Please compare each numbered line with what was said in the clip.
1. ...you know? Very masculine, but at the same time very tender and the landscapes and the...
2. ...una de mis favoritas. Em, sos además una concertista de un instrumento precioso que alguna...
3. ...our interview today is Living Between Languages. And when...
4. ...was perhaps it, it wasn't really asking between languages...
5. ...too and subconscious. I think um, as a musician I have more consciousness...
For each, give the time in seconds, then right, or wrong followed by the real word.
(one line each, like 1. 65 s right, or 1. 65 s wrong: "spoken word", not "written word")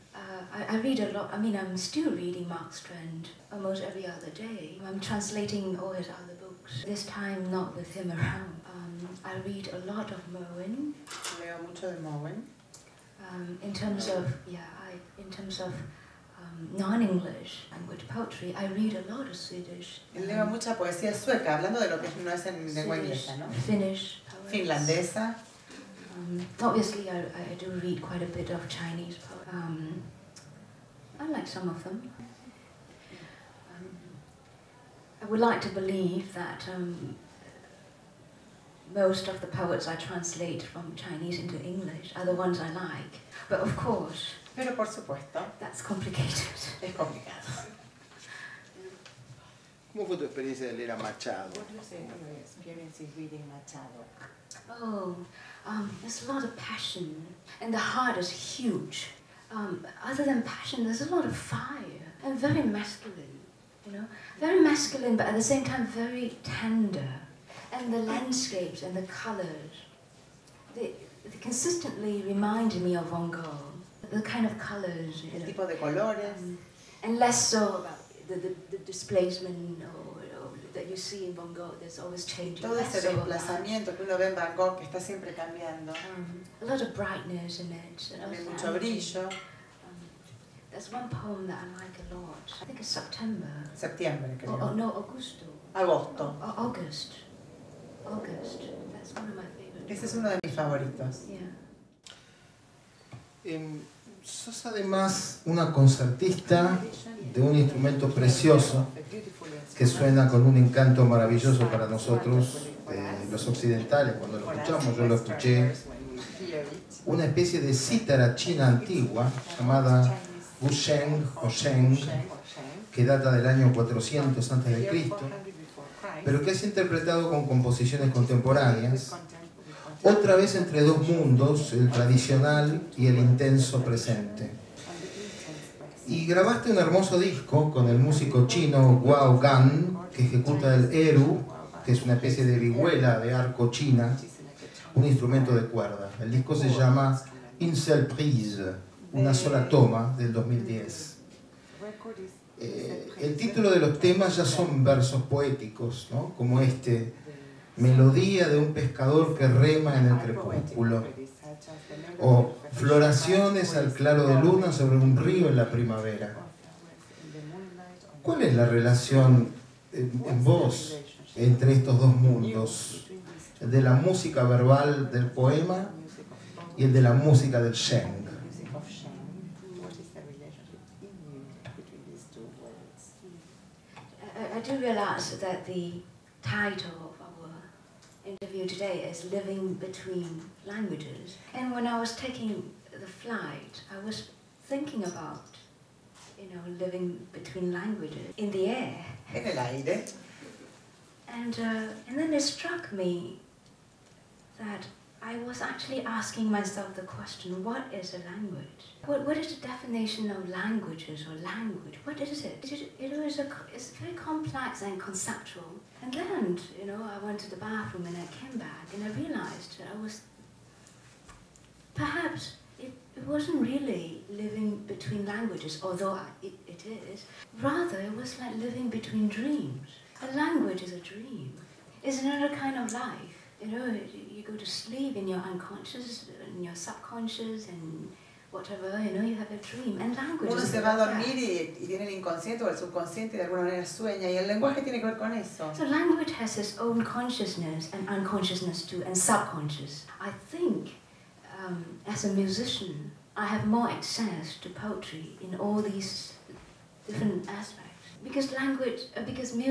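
1. 63 s right
2. 100 s wrong: "suena", not "alguna"
3. 187 s right
4. 220 s wrong: "living", not "asking"
5. 248 s wrong: "access", not "consciousness".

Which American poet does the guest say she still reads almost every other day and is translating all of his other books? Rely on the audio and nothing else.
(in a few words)
Mark Strand.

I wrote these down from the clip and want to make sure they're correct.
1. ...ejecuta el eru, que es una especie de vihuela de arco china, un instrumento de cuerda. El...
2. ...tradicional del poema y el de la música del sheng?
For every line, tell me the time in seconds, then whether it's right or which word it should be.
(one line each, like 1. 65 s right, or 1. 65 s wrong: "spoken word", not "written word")
1. 140 s right
2. 174 s wrong: "verbal", not "tradicional".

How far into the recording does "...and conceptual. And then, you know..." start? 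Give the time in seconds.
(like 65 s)
214 s.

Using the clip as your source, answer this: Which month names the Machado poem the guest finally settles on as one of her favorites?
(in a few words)
August.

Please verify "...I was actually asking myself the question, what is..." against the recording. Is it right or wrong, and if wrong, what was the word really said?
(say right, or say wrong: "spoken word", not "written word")
right.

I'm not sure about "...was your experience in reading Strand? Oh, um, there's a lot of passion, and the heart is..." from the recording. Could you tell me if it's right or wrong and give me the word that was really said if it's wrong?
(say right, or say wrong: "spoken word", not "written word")
wrong: "Machado", not "Strand".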